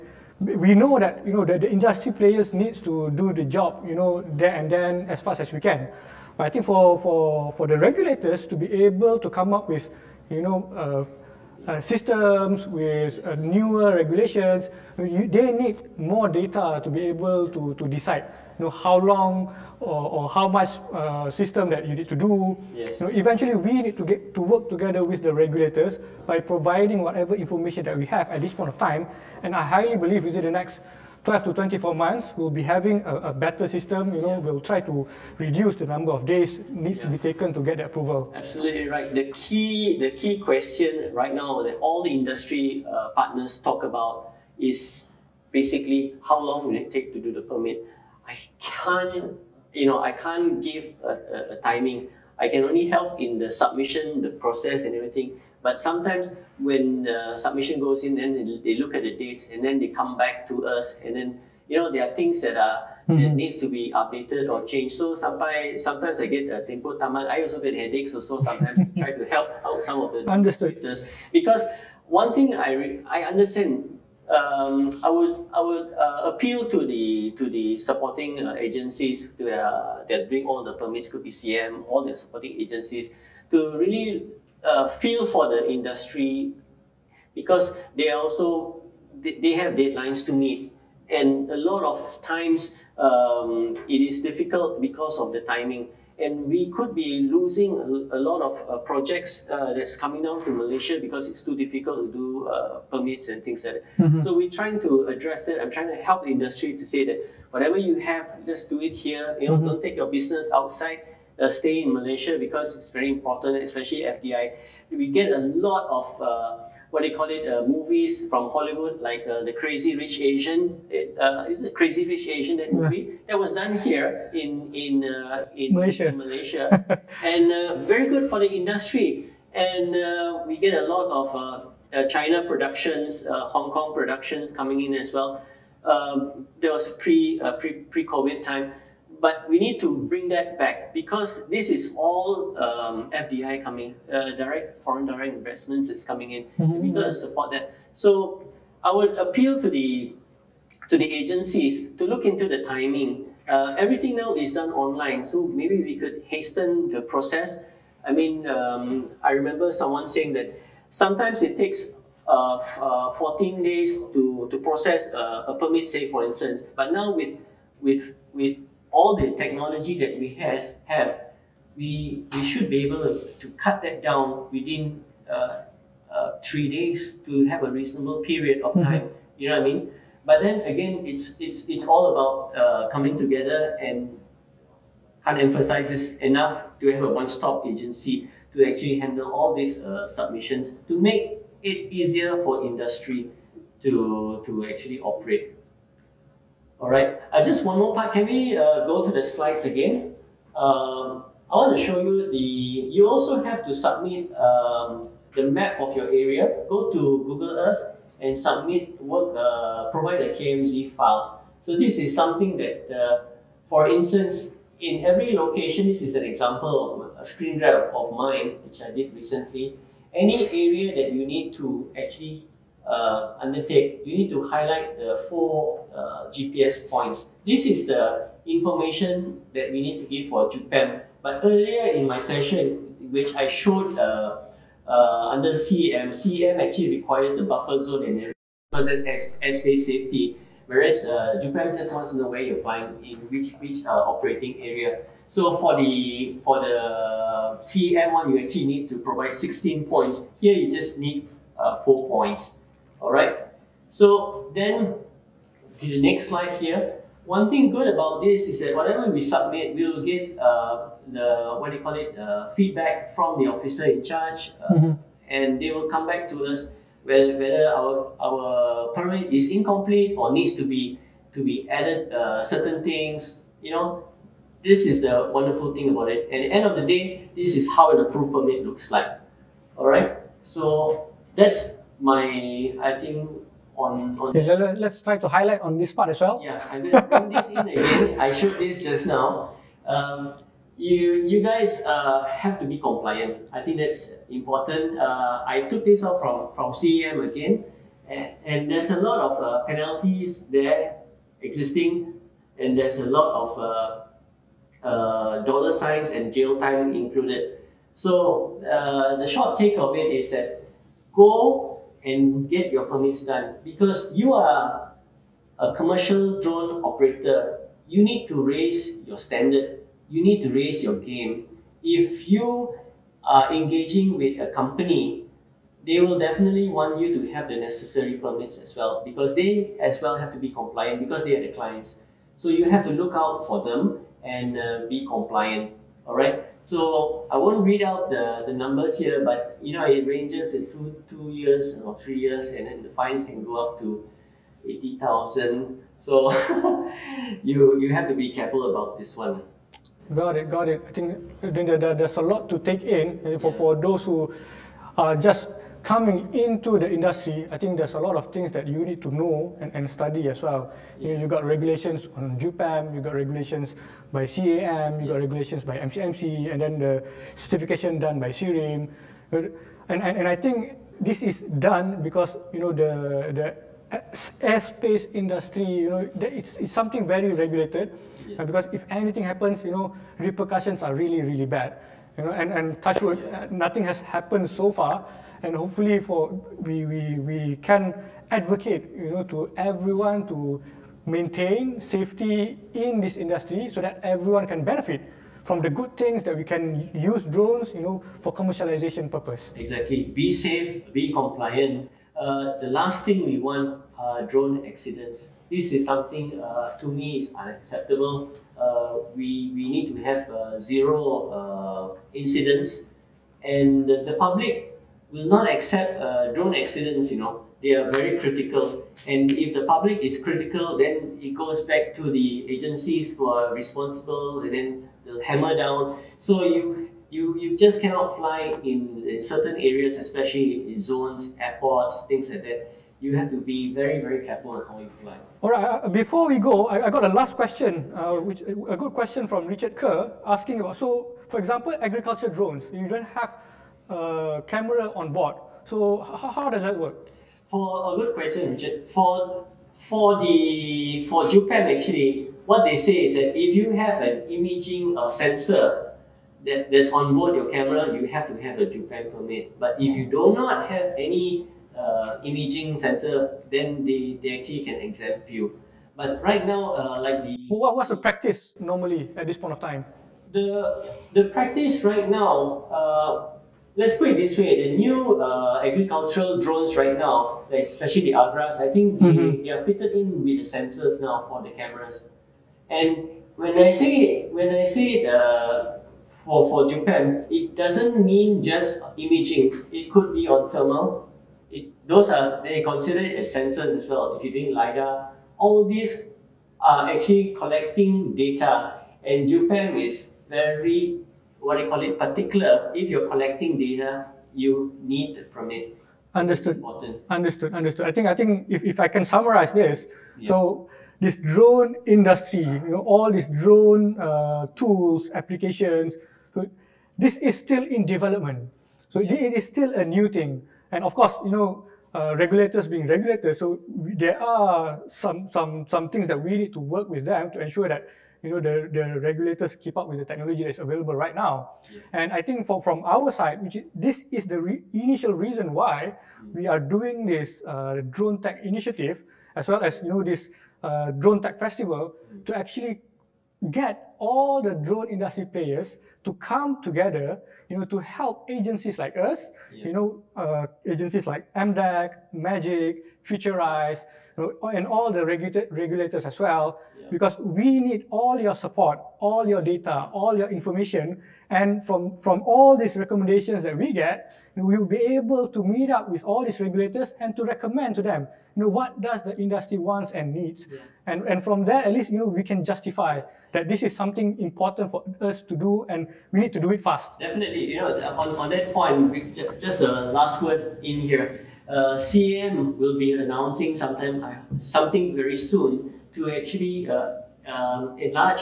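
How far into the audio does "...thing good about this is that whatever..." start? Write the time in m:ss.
4:17.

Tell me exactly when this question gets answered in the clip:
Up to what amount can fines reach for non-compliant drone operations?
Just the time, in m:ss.
5:44.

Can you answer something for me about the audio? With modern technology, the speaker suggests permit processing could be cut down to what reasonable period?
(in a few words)
3 days.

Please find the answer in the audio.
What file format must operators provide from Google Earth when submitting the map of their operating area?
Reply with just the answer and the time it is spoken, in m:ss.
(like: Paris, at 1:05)
KMZ, at 3:30.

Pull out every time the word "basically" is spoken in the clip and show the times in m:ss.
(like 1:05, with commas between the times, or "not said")
0:45.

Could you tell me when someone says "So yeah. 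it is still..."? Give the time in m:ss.
8:38.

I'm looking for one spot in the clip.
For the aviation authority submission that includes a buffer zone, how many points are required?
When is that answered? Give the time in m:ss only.
4:09.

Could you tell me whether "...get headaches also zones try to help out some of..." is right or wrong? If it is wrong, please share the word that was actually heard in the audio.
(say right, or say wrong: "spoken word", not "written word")
wrong: "sometimes", not "zones".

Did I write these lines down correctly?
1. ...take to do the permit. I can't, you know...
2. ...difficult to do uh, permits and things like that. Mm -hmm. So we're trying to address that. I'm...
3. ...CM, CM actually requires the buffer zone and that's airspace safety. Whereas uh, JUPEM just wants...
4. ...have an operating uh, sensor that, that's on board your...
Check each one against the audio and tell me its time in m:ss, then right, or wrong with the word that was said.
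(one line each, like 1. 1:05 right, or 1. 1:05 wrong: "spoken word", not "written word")
1. 0:46 right
2. 1:41 right
3. 3:55 right
4. 7:33 wrong: "imaging", not "operating".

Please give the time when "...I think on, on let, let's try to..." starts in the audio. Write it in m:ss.
4:42.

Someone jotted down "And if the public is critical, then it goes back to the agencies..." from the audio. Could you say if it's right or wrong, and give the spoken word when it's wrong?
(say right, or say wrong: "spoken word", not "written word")
right.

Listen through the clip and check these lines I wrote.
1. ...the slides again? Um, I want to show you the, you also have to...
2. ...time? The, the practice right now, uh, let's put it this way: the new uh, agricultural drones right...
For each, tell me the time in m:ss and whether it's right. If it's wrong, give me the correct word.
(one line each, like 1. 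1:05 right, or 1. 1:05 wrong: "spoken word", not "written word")
1. 3:19 right
2. 7:49 right.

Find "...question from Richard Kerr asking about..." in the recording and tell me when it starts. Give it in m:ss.
7:18.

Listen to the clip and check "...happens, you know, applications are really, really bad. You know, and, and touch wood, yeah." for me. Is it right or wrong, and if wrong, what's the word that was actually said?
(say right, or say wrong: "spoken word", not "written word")
wrong: "repercussions", not "applications".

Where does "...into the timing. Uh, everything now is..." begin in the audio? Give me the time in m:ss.
2:32.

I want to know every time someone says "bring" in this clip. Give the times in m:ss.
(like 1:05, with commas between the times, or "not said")
1:20, 2:20.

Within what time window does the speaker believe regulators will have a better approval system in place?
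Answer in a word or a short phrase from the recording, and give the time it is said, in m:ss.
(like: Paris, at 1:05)
12 to 24 months, at 0:31.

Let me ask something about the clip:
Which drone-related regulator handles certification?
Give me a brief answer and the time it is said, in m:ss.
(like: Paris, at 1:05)
SIRIM, at 6:08.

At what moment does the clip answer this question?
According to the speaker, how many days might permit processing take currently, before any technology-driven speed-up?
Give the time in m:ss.
2:43.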